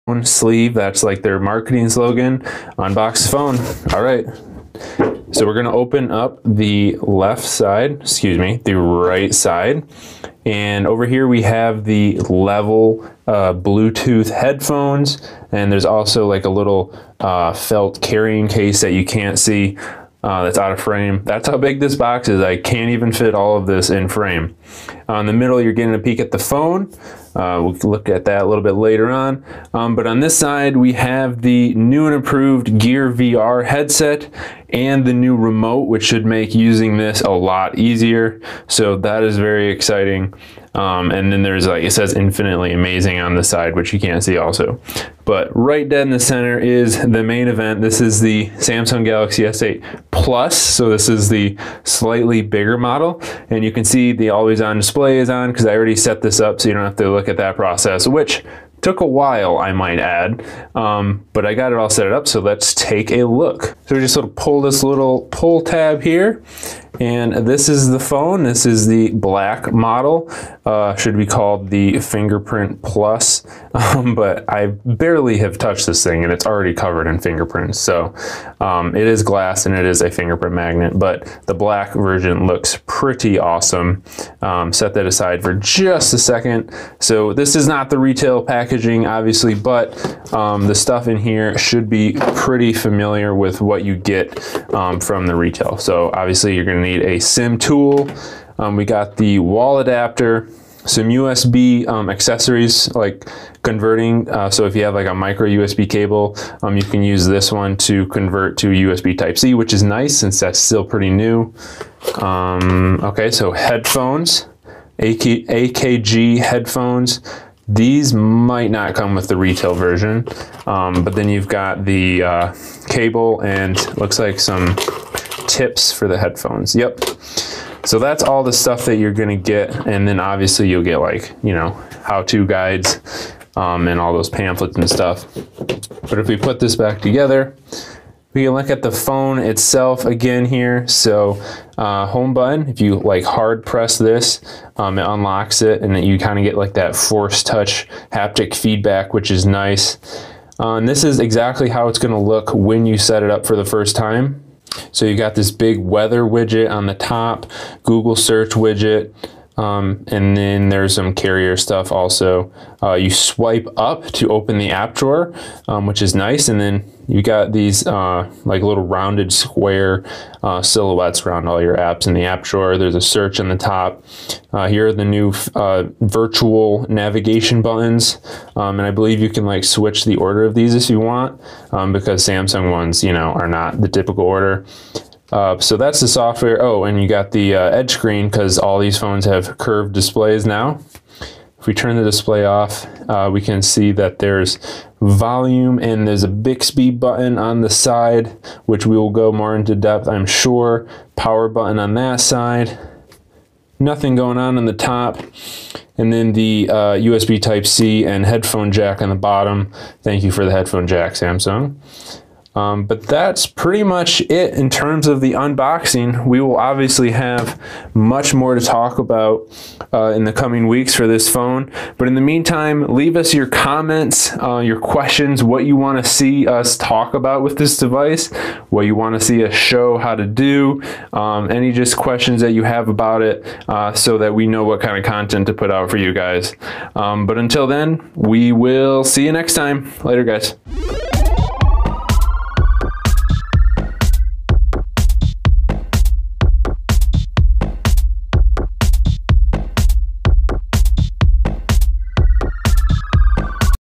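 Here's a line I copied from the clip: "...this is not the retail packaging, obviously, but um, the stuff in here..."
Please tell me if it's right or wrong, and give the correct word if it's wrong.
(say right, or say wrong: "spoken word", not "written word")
right.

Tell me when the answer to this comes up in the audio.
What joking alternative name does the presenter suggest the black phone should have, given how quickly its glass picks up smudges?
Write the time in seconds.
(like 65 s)
71 s.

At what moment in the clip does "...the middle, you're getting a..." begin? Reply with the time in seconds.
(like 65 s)
25 s.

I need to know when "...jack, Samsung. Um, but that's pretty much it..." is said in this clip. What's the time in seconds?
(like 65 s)
210 s.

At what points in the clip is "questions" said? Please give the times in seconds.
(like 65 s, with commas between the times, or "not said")
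224 s, 231 s.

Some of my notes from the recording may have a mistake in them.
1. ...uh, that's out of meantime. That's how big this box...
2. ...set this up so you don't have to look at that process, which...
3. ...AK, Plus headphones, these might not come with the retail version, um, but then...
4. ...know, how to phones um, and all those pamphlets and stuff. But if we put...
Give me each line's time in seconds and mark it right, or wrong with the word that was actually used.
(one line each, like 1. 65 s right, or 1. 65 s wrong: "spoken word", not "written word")
1. 20 s wrong: "frame", not "meantime"
2. 55 s right
3. 114 s wrong: "AKG", not "Plus"
4. 131 s wrong: "guides", not "phones".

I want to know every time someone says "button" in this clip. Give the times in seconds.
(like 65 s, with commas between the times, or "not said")
142 s, 177 s, 196 s, 201 s.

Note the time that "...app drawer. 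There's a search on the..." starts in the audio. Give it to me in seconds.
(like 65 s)
172 s.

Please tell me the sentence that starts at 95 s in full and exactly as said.
So obviously you're gonna need a SIM tool.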